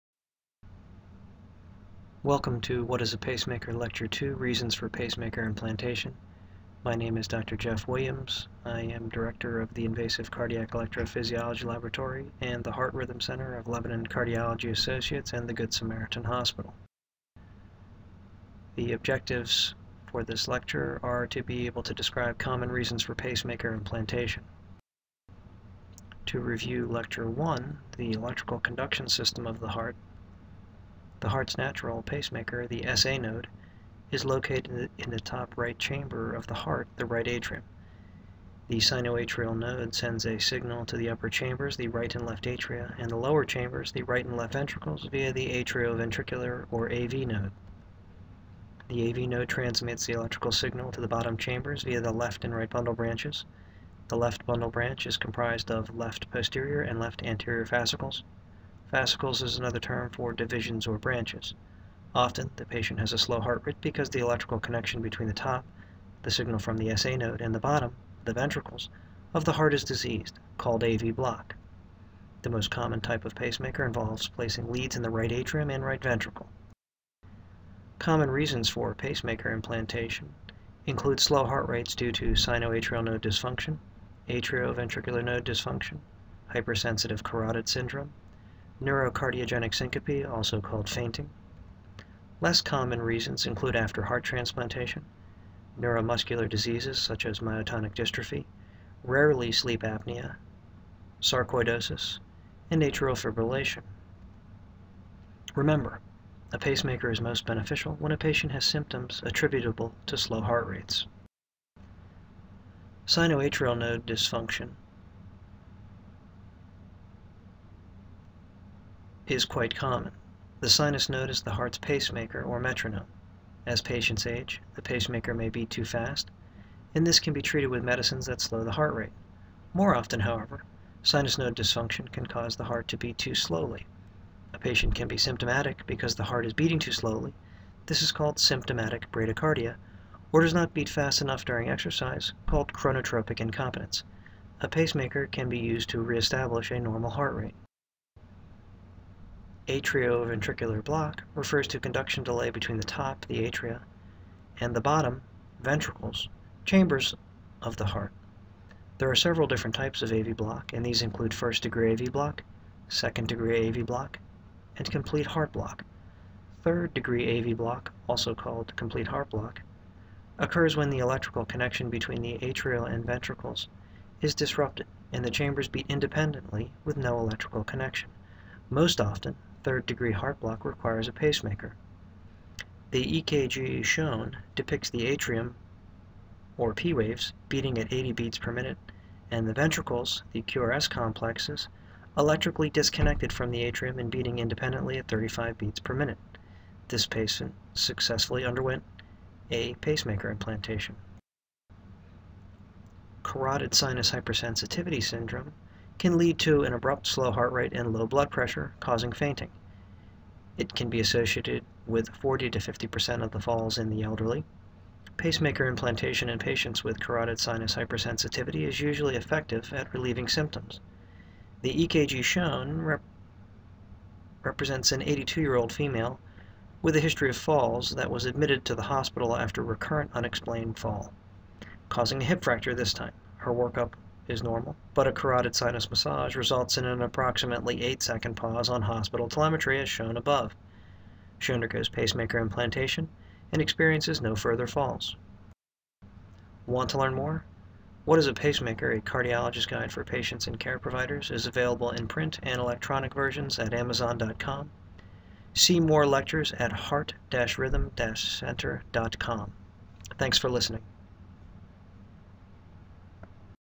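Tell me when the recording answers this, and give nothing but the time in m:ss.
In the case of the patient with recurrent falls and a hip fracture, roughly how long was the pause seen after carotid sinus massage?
3:57.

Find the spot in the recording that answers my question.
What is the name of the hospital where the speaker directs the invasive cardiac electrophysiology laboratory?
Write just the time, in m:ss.
0:15.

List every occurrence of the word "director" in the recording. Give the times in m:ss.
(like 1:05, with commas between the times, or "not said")
0:09.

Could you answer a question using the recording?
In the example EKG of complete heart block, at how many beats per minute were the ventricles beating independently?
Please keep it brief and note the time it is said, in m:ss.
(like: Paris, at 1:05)
35, at 3:15.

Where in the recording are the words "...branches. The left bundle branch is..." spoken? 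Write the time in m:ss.
0:52.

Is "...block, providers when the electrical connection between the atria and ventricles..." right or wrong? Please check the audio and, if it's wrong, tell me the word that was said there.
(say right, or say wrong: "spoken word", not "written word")
wrong: "occurs", not "providers".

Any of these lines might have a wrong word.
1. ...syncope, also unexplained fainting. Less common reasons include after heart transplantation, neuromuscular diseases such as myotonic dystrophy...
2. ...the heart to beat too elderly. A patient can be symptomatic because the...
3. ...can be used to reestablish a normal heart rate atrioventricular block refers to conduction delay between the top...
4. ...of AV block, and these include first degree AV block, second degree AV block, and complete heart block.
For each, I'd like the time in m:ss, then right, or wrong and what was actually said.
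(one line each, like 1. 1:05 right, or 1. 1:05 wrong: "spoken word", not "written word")
1. 1:29 wrong: "called", not "unexplained"
2. 2:12 wrong: "slowly", not "elderly"
3. 2:25 right
4. 2:40 right.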